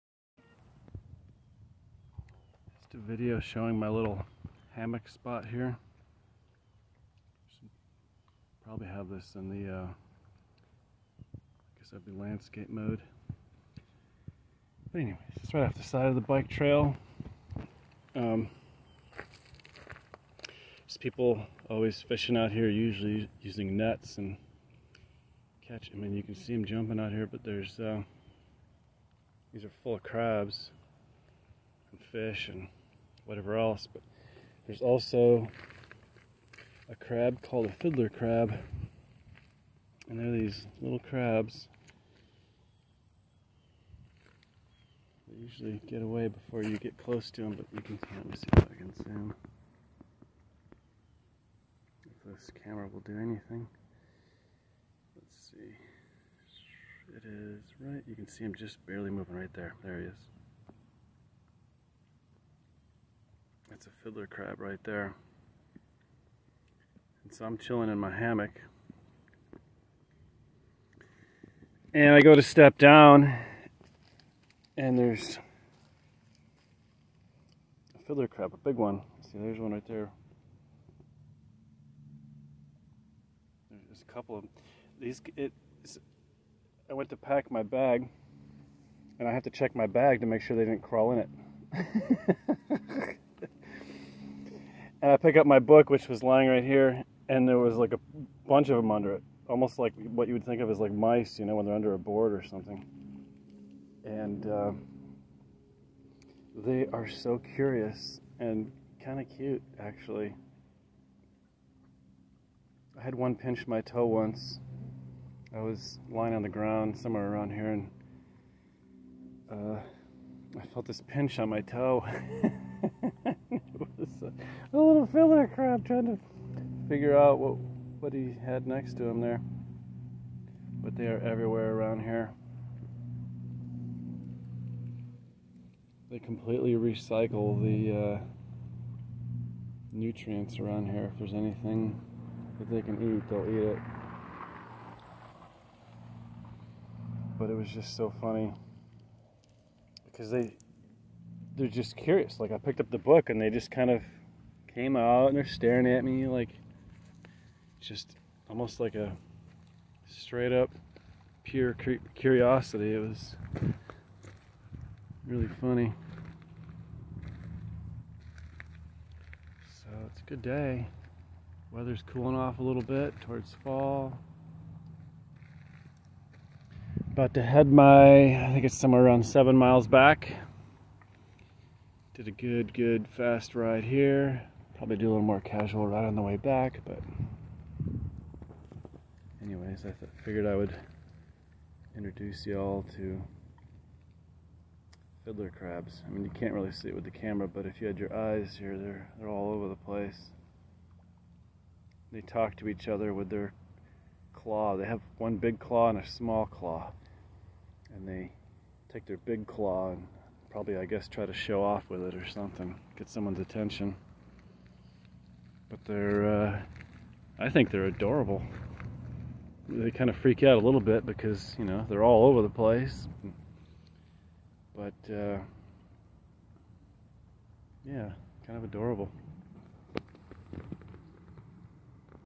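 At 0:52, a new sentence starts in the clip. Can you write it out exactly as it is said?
If this camera will do anything.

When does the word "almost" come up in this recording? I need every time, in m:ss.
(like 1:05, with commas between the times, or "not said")
1:39, 2:38.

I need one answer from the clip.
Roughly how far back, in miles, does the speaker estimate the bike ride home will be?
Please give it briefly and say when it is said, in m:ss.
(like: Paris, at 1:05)
7, at 2:59.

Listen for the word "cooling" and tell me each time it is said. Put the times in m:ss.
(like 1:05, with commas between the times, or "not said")
2:52.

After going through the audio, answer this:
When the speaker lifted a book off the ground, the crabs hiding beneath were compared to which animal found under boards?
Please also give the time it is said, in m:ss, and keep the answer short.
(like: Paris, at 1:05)
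Mice, at 1:40.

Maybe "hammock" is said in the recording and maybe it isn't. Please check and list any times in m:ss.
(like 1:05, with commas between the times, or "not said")
0:04, 1:08.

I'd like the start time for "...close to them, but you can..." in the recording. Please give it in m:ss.
0:46.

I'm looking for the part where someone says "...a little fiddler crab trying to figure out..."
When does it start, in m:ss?
2:04.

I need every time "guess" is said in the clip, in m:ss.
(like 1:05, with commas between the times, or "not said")
0:11, 3:30.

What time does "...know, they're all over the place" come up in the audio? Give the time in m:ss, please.
3:41.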